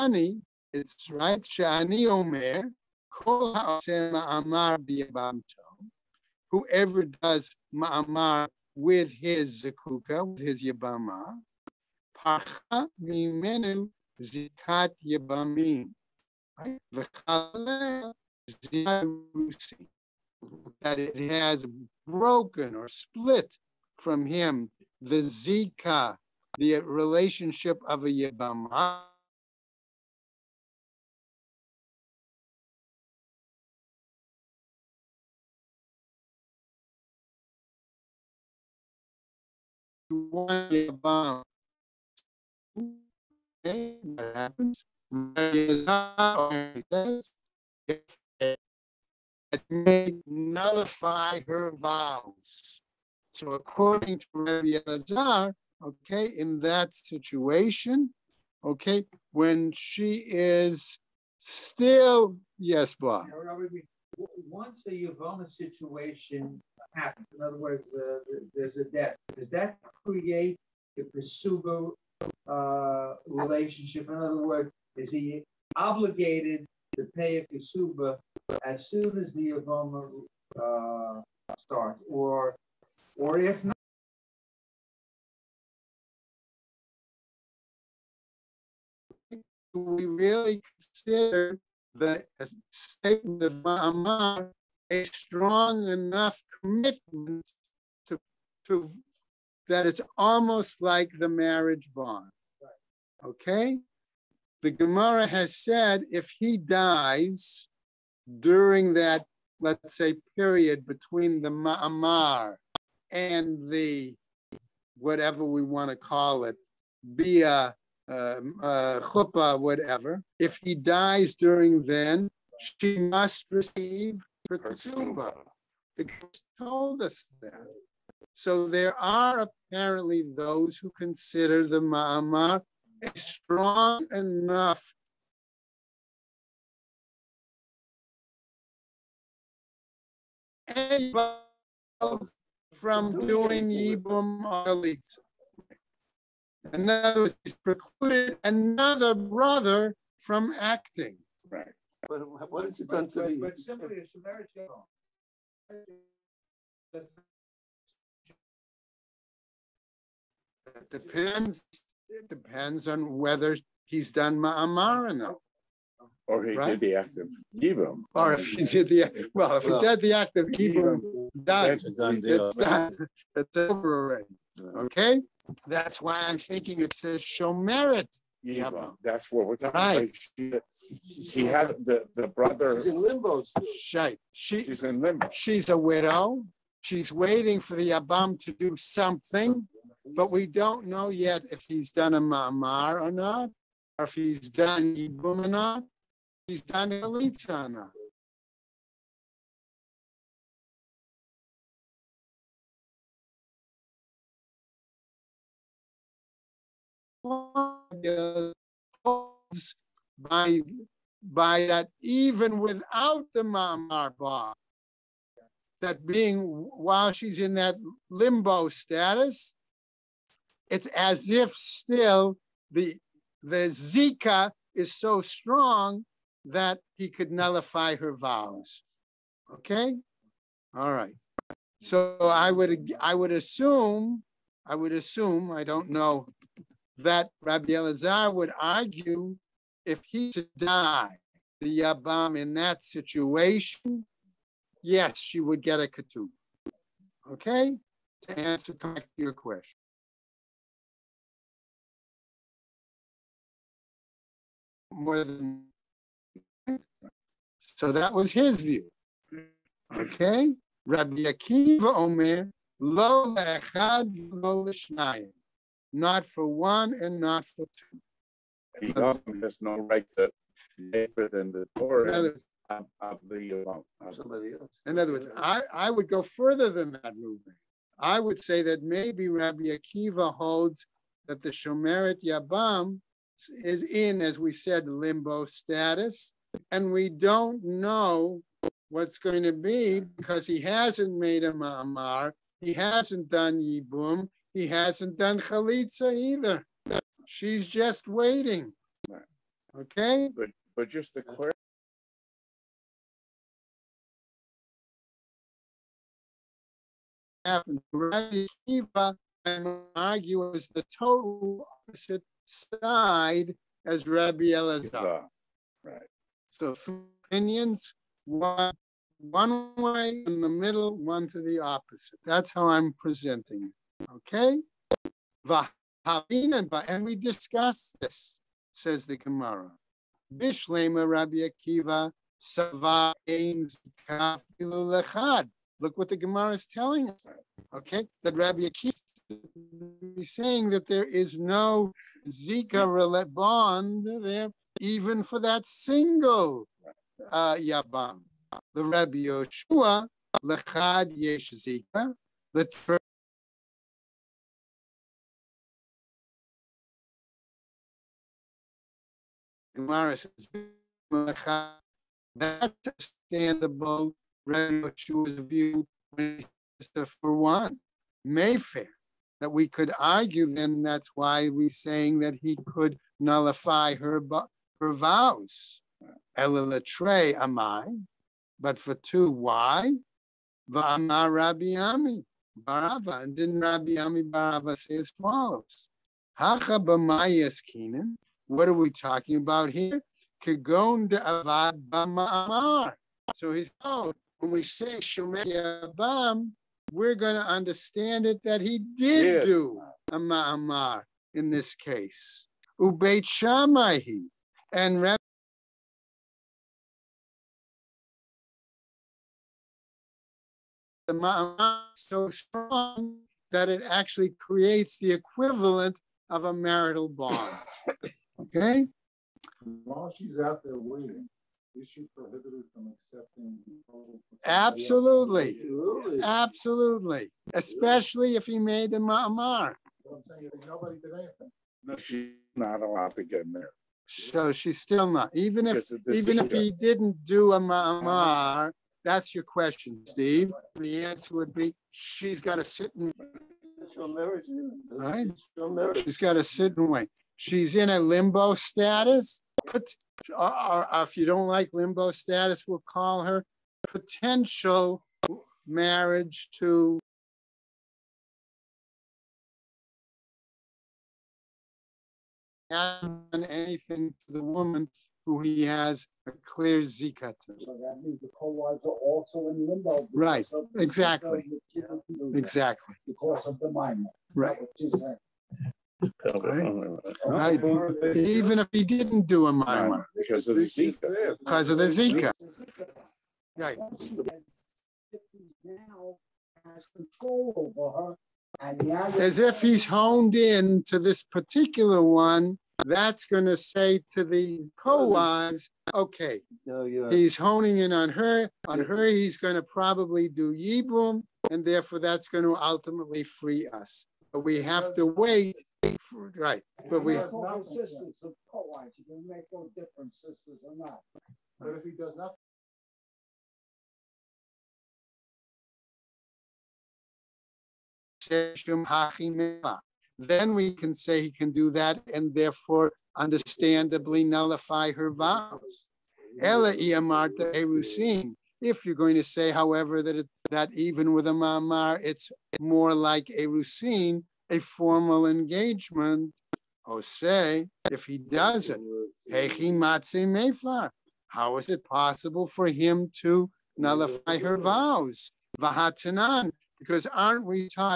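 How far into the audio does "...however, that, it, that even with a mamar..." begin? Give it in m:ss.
8:49.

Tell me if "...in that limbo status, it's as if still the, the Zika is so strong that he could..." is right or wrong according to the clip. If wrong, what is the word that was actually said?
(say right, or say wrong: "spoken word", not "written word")
right.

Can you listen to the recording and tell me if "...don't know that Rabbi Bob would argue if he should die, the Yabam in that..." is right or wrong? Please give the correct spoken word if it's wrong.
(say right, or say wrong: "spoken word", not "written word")
wrong: "Elazar", not "Bob".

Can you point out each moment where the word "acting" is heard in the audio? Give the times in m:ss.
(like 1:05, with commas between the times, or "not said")
2:30.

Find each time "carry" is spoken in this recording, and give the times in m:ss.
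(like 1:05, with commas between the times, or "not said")
not said.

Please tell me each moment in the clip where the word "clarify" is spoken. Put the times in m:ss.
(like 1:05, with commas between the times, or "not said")
5:01.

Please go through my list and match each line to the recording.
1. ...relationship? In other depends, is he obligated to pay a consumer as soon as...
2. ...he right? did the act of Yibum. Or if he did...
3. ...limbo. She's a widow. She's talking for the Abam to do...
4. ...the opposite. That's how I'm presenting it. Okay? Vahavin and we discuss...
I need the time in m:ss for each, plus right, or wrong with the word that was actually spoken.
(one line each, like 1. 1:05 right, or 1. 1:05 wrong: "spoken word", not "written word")
1. 1:13 wrong: "words", not "depends"
2. 2:46 right
3. 3:05 wrong: "waiting", not "talking"
4. 5:21 right.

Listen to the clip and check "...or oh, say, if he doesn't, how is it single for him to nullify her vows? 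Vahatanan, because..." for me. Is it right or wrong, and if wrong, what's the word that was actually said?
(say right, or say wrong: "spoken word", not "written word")
wrong: "possible", not "single".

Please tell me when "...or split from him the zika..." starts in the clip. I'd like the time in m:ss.
0:22.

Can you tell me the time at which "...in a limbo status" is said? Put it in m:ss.
7:27.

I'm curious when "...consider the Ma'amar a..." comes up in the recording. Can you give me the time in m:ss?
2:10.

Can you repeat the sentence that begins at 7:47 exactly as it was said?
So that means the co-wives are also in limbo.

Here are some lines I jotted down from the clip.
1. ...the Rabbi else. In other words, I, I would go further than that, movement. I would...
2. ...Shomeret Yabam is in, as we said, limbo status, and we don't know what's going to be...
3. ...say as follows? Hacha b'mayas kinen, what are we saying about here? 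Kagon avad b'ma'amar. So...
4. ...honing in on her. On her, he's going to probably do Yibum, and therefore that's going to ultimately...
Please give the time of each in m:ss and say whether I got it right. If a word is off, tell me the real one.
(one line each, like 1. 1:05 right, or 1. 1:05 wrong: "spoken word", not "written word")
1. 4:33 wrong: "Somebody", not "Rabbi"
2. 4:41 right
3. 6:24 wrong: "talking", not "saying"
4. 8:17 right.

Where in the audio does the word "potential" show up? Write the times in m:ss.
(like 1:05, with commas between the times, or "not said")
7:33.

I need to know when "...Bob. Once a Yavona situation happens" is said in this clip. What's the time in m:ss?
1:02.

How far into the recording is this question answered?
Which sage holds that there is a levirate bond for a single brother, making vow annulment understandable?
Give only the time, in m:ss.
5:48.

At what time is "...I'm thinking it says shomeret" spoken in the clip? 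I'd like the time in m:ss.
2:56.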